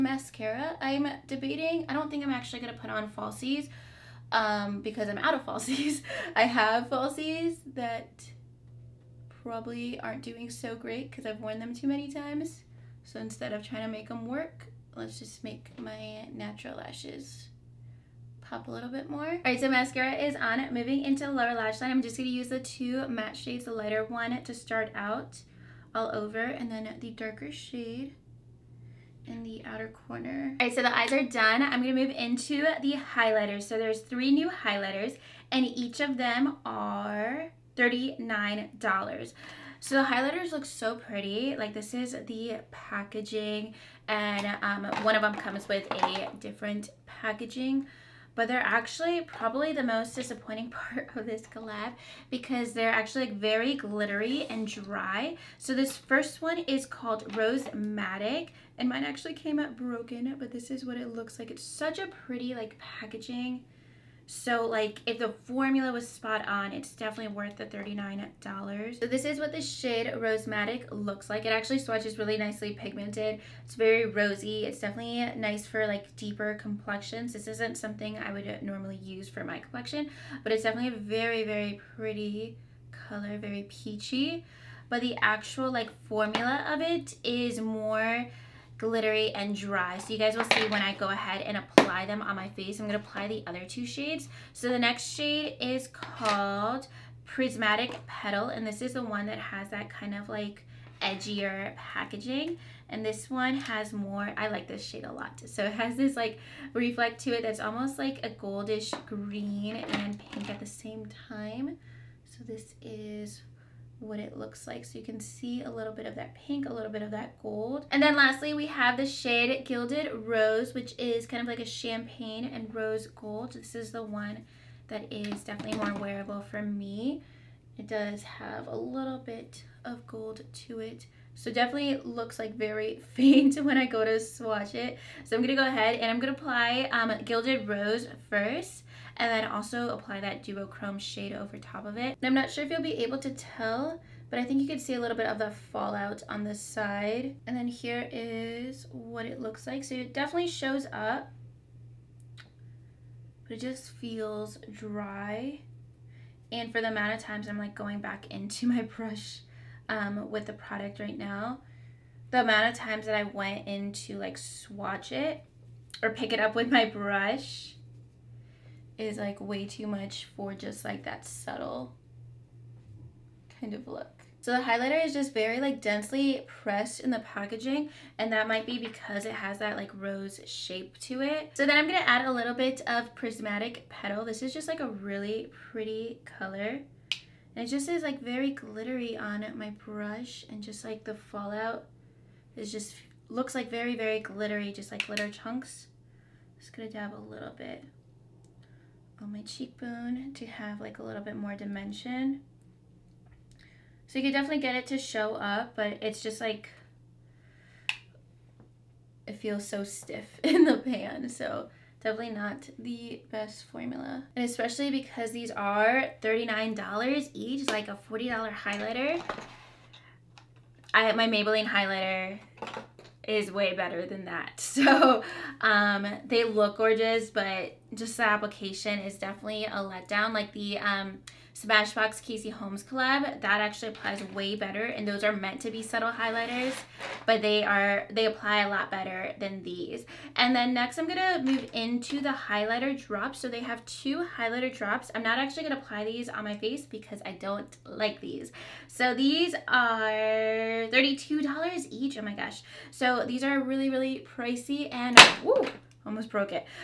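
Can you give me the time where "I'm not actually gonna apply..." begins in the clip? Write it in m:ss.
4:05.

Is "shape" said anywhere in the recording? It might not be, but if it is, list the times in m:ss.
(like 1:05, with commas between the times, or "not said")
3:00.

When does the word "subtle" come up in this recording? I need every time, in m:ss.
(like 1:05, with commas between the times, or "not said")
2:51, 3:55.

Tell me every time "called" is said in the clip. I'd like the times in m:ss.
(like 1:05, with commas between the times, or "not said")
0:56, 1:35.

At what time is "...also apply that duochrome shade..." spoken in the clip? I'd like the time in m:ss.
2:19.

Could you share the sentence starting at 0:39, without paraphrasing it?
So the highlighters look so pretty.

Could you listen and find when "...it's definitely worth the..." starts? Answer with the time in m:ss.
1:06.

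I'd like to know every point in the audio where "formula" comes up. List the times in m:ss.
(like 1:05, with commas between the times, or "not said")
1:05, 1:26, 3:33.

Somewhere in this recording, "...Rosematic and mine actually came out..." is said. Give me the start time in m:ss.
0:57.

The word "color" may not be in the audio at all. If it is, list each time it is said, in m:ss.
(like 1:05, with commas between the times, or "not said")
1:22, 3:06.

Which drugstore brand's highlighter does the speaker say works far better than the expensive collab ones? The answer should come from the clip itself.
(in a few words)
Maybelline.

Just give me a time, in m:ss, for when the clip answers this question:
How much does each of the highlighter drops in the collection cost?
4:10.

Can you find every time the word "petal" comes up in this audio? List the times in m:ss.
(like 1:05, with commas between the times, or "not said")
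1:38, 3:03.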